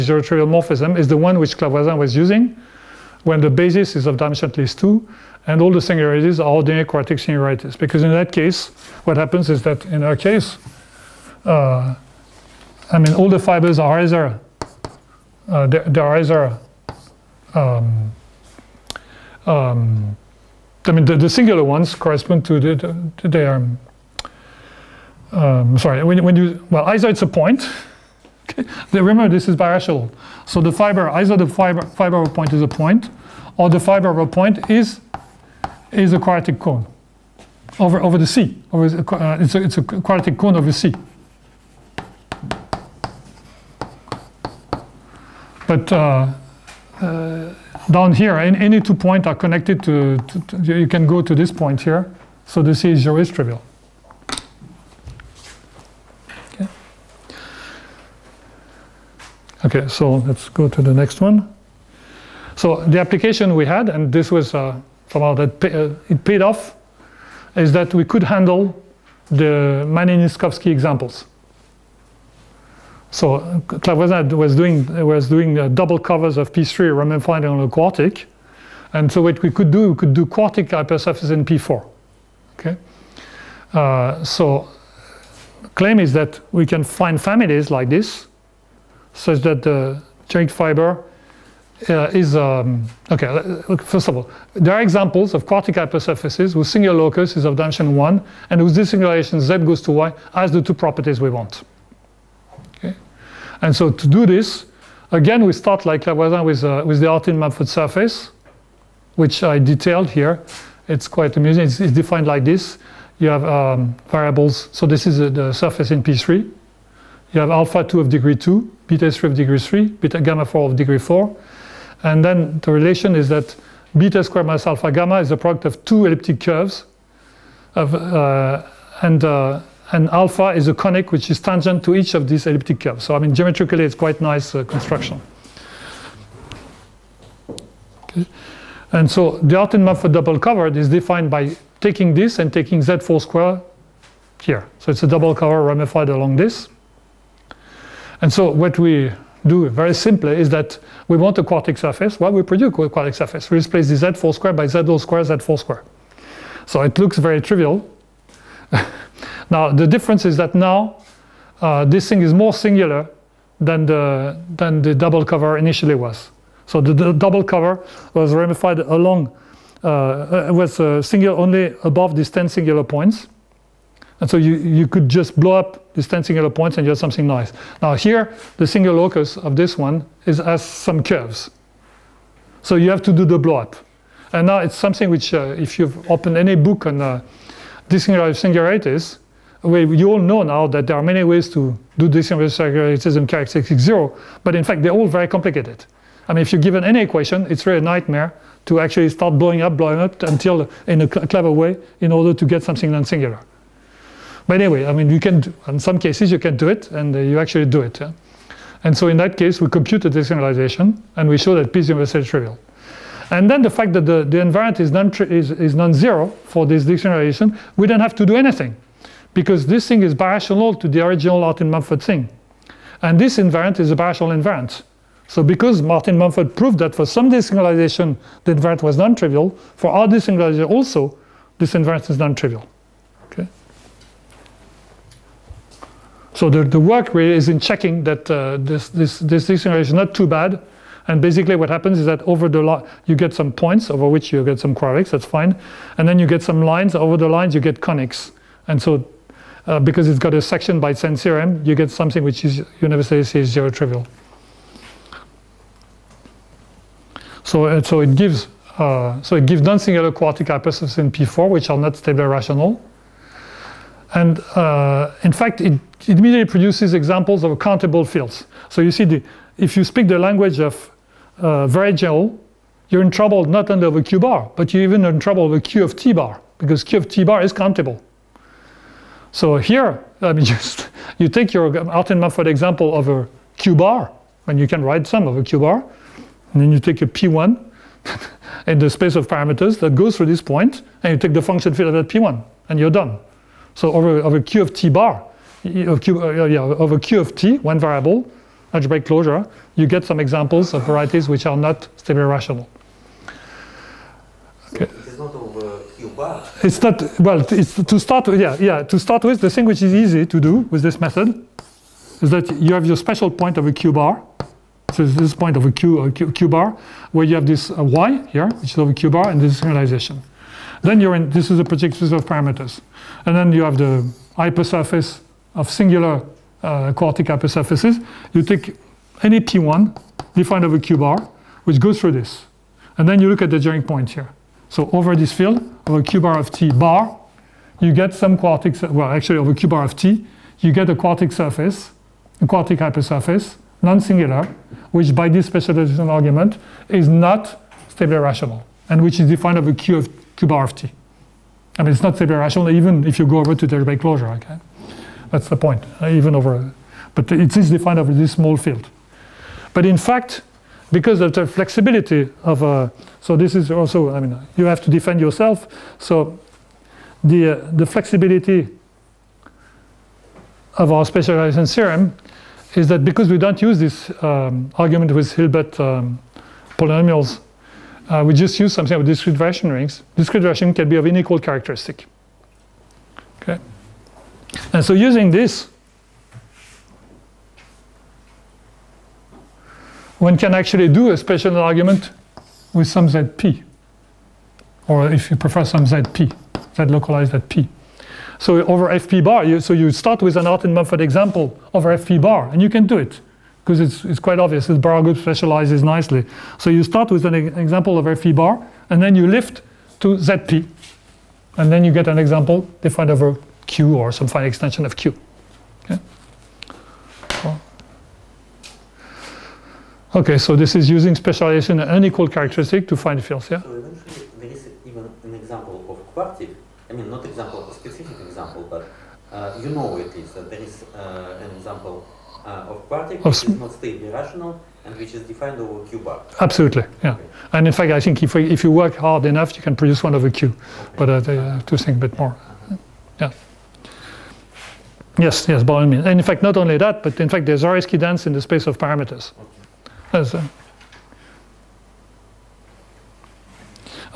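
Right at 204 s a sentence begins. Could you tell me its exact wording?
But anyway, I mean, you can, do, in some cases, you can do it, and uh, you actually do it.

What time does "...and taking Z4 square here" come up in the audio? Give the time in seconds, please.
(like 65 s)
142 s.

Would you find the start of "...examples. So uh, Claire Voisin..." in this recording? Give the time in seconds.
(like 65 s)
70 s.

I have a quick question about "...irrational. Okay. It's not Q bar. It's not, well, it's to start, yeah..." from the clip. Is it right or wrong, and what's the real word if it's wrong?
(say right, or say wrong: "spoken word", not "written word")
wrong: "rational", not "irrational".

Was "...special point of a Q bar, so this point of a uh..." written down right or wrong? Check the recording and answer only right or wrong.
right.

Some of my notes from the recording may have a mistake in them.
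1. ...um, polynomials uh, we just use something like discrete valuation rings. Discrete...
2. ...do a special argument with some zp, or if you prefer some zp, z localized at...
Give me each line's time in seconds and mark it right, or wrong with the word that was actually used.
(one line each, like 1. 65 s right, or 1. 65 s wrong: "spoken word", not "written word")
1. 375 s right
2. 390 s right.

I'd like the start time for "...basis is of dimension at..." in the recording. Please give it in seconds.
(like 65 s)
3 s.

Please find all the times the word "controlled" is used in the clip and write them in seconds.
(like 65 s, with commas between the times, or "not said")
not said.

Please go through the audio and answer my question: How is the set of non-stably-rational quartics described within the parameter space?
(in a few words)
Zariski dense.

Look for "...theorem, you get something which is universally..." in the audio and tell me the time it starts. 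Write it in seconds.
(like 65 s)
251 s.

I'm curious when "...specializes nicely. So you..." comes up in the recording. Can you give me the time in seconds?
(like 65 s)
405 s.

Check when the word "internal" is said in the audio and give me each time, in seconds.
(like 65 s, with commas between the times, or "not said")
not said.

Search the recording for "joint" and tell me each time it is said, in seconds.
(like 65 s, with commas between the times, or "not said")
90 s, 333 s.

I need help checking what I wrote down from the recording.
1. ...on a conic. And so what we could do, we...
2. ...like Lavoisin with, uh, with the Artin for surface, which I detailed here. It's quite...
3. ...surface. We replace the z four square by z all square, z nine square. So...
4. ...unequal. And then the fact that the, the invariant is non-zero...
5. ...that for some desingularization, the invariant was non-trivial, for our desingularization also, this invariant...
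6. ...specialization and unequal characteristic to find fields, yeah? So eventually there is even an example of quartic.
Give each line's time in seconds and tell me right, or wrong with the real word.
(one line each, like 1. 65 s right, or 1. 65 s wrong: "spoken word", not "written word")
1. 77 s wrong: "quartic", not "conic"
2. 105 s right
3. 153 s wrong: "four", not "nine"
4. 212 s wrong: "trivial", not "unequal"
5. 226 s right
6. 421 s right.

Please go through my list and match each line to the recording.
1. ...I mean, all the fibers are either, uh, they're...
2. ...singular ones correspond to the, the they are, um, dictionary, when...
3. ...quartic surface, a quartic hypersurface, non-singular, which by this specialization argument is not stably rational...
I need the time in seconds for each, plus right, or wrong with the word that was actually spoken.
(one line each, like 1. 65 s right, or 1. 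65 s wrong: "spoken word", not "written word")
1. 12 s right
2. 21 s wrong: "sorry", not "dictionary"
3. 340 s right.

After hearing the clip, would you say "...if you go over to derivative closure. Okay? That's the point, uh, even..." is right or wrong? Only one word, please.
right.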